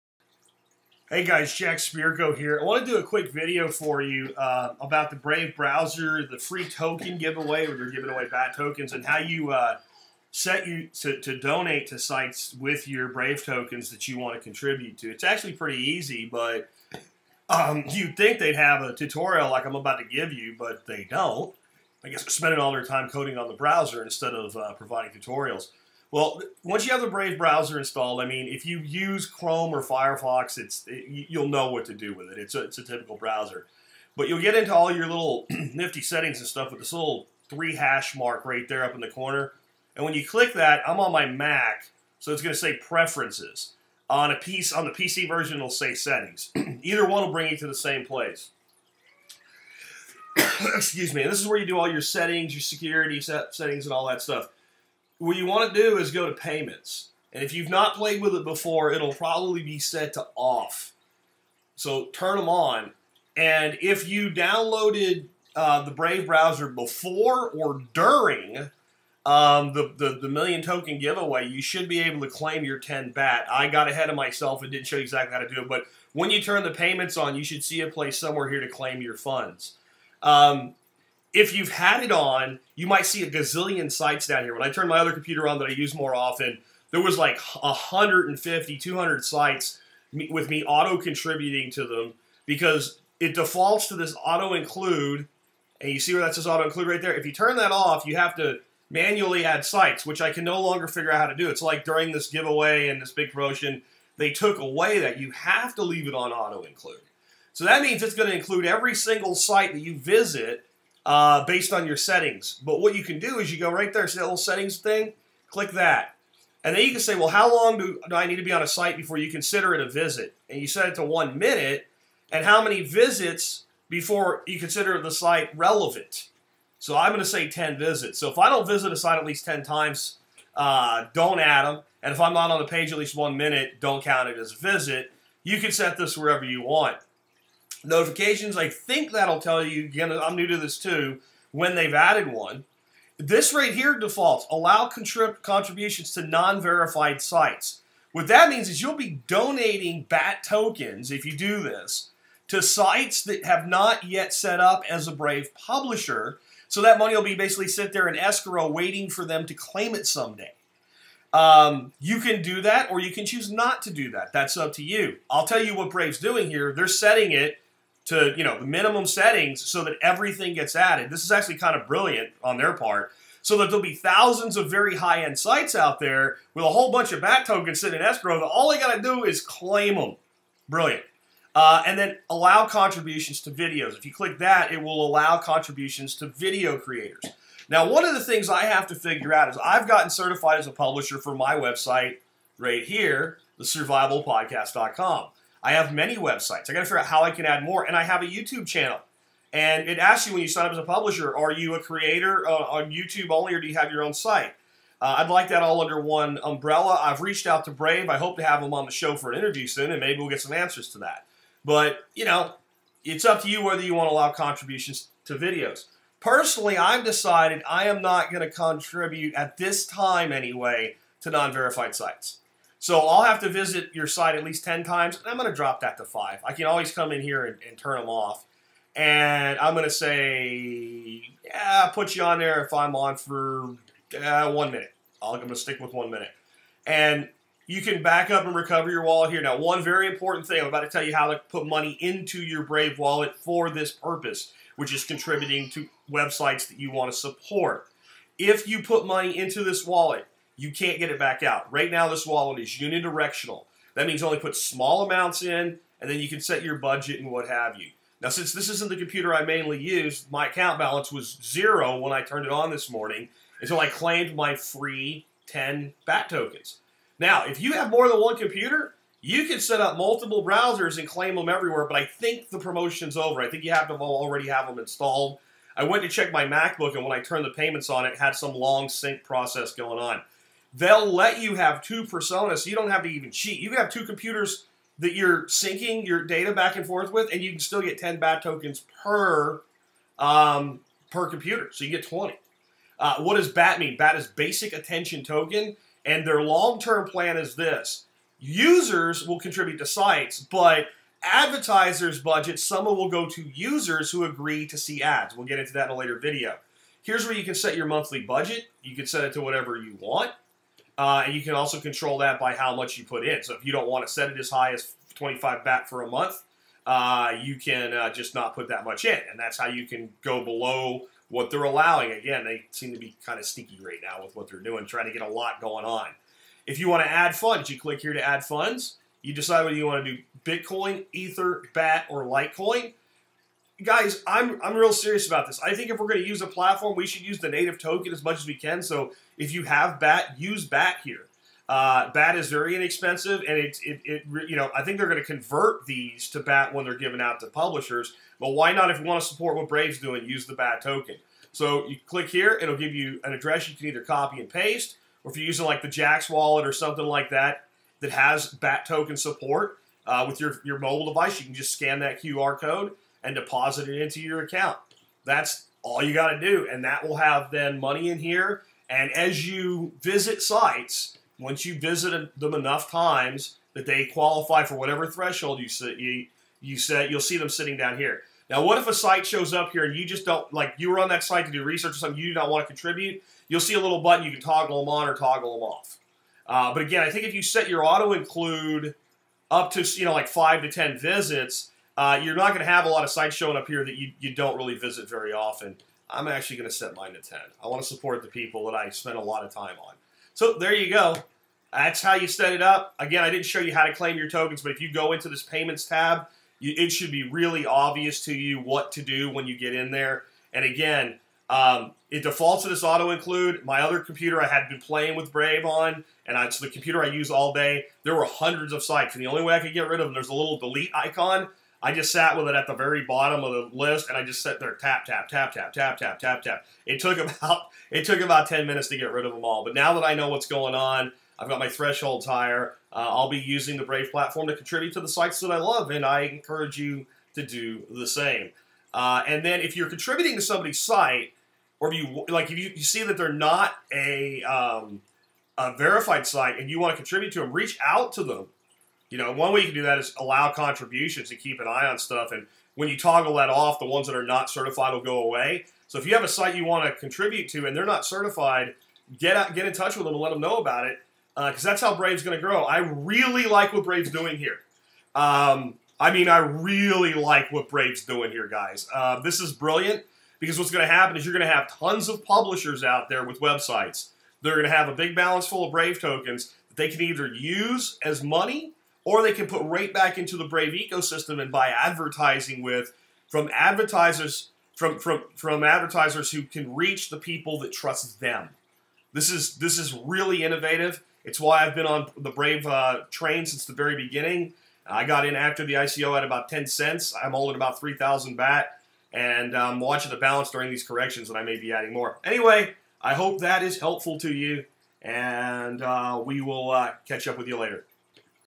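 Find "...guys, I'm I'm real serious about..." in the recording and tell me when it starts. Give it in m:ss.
5:33.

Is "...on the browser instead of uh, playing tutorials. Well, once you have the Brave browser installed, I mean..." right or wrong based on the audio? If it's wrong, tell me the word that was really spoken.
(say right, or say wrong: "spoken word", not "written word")
wrong: "providing", not "playing".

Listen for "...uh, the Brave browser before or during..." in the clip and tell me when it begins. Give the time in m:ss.
1:05.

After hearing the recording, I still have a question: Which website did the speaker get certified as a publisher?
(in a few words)
thesurvivalpodcast.com.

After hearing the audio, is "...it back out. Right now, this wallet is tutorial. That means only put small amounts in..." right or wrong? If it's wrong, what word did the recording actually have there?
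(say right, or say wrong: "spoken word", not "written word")
wrong: "unidirectional", not "tutorial".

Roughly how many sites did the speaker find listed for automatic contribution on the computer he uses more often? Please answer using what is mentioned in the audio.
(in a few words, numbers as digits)
150 to 200.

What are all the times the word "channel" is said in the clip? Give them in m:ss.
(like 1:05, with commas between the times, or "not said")
3:18.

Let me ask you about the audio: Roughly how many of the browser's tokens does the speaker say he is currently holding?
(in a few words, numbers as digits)
3,000.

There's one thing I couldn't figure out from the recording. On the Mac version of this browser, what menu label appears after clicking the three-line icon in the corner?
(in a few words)
Preferences.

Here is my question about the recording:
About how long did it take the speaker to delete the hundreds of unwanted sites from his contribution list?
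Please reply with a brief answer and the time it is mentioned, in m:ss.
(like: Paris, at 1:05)
10 minutes, at 7:08.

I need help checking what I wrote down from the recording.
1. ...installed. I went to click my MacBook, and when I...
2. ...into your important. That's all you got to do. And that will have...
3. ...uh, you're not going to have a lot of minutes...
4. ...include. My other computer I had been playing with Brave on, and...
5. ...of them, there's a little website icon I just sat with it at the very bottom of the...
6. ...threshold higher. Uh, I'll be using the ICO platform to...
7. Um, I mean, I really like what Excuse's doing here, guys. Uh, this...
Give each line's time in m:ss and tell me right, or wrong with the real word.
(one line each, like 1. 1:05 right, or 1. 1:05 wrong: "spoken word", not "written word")
1. 4:34 wrong: "check", not "click"
2. 6:04 wrong: "account", not "important"
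3. 6:31 wrong: "sites", not "minutes"
4. 6:53 right
5. 7:00 wrong: "delete", not "website"
6. 7:11 wrong: "Brave", not "ICO"
7. 7:45 wrong: "Brave", not "Excuse".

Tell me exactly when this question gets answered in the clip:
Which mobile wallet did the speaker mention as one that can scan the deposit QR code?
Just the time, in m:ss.
5:55.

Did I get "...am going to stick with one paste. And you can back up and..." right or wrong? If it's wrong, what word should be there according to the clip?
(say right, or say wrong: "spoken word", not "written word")
wrong: "minute", not "paste".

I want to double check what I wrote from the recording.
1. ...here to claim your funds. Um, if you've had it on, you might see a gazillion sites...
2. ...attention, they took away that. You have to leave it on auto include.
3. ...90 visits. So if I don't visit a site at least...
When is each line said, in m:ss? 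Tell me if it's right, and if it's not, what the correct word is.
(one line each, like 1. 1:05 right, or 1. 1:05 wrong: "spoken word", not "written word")
1. 1:18 right
2. 1:43 wrong: "promotion", not "attention"
3. 2:07 wrong: "10", not "90".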